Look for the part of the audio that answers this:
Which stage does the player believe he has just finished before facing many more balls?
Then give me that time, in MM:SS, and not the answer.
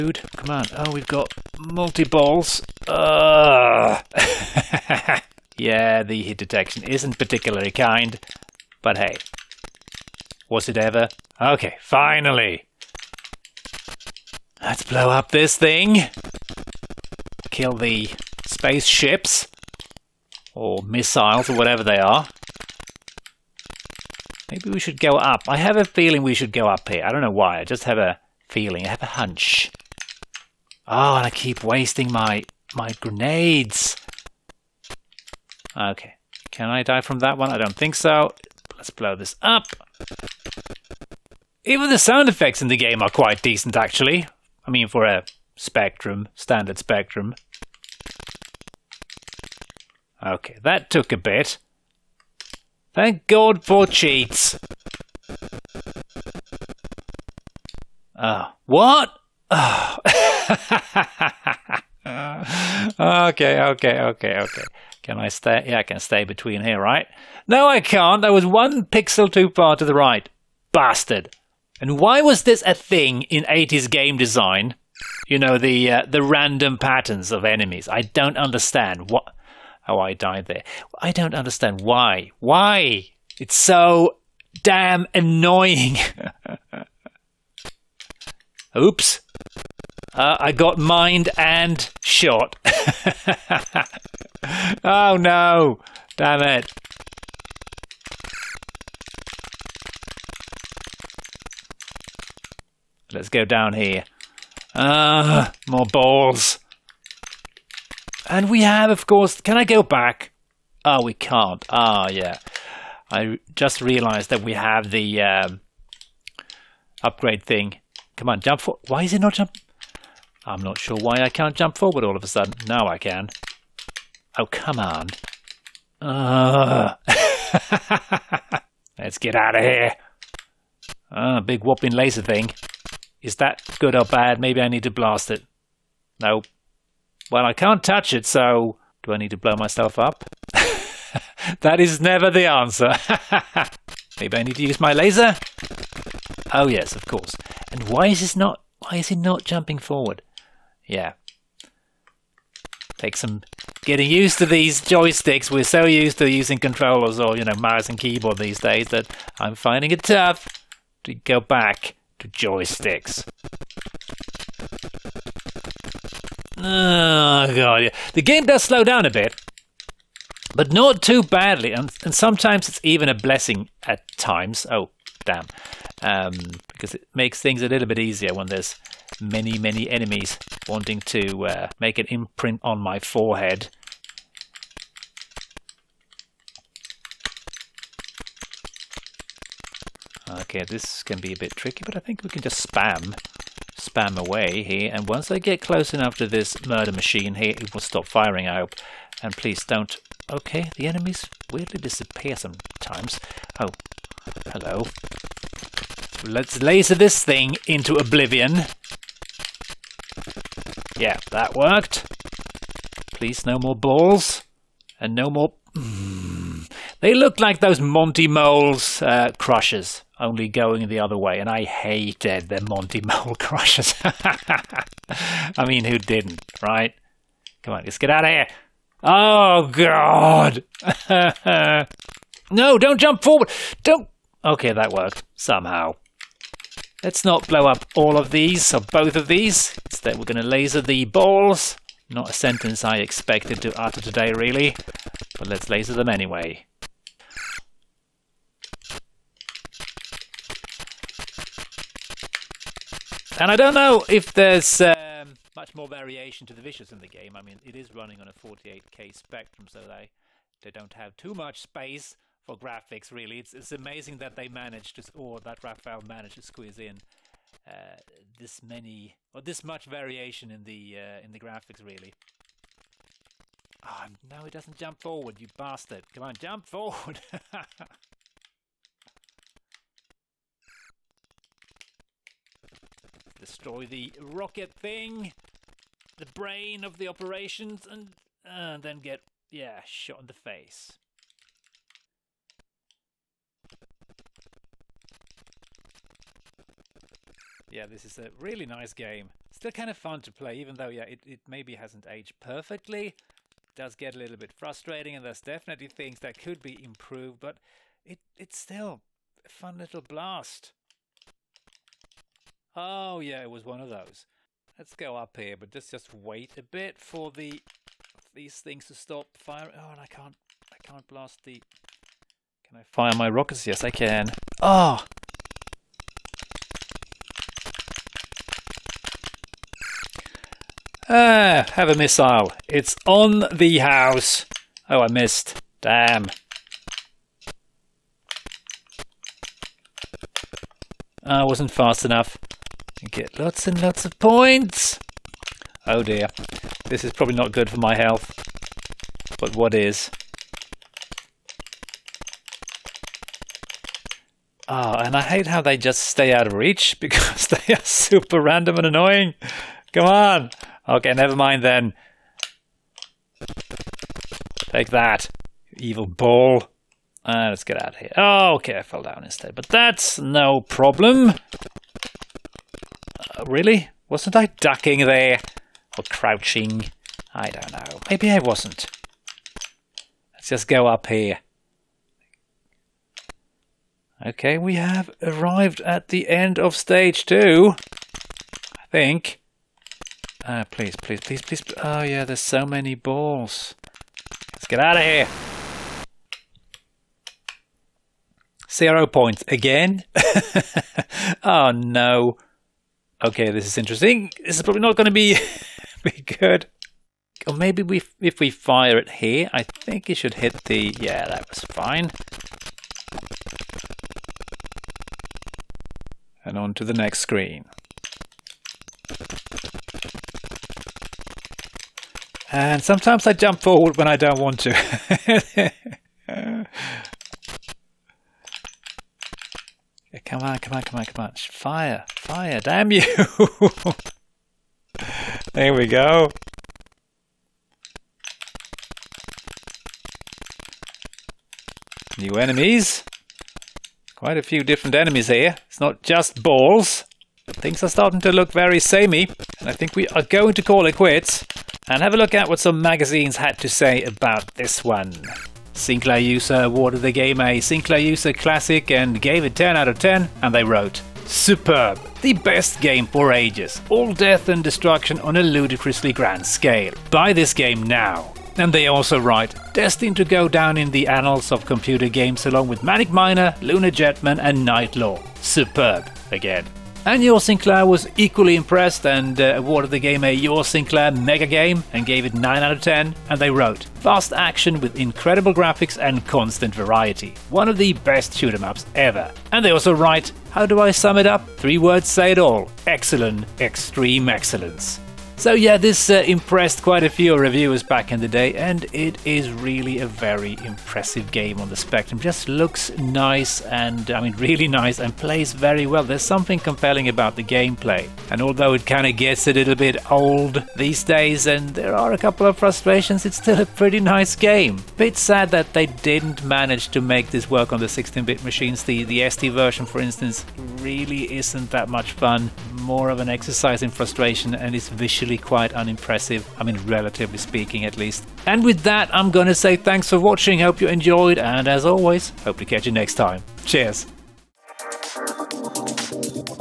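06:26.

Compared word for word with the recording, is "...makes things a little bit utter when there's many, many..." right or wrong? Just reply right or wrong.
wrong.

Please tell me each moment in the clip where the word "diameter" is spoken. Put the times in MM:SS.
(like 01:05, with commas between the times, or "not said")
not said.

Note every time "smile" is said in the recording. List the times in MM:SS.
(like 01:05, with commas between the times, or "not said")
not said.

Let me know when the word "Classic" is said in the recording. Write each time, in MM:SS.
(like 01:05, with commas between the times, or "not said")
07:38.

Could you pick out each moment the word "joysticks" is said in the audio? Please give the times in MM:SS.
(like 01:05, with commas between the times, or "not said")
02:34, 02:42.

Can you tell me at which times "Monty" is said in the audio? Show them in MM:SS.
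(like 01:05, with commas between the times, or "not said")
03:37, 03:42.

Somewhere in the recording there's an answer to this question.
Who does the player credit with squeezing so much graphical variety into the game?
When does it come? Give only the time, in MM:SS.
04:25.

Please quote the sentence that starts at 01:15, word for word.
You know, the uh, the random patterns of enemies.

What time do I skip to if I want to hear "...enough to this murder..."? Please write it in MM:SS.
03:15.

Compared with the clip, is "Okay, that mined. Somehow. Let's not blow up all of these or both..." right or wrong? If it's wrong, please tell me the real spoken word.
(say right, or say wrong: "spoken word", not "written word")
wrong: "worked", not "mined".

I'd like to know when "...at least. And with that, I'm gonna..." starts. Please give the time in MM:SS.
08:47.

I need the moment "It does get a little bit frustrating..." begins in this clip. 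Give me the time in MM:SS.
05:03.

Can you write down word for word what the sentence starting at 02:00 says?
I'm not sure why I can't jump forward all of a sudden.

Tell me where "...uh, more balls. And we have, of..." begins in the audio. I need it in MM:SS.
01:45.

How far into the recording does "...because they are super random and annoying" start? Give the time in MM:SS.
05:56.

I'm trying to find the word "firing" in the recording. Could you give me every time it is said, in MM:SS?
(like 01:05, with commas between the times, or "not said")
03:18, 05:19.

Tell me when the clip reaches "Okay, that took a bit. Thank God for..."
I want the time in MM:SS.
00:50.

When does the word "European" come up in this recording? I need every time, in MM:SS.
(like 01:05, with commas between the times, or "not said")
not said.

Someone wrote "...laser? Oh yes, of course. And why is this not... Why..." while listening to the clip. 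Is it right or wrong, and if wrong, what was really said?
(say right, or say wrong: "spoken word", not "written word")
right.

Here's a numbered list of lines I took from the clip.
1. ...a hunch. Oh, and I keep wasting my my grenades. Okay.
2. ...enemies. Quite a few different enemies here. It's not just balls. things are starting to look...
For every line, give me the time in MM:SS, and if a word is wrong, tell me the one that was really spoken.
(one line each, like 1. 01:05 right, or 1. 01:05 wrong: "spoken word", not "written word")
1. 00:29 right
2. 07:22 right.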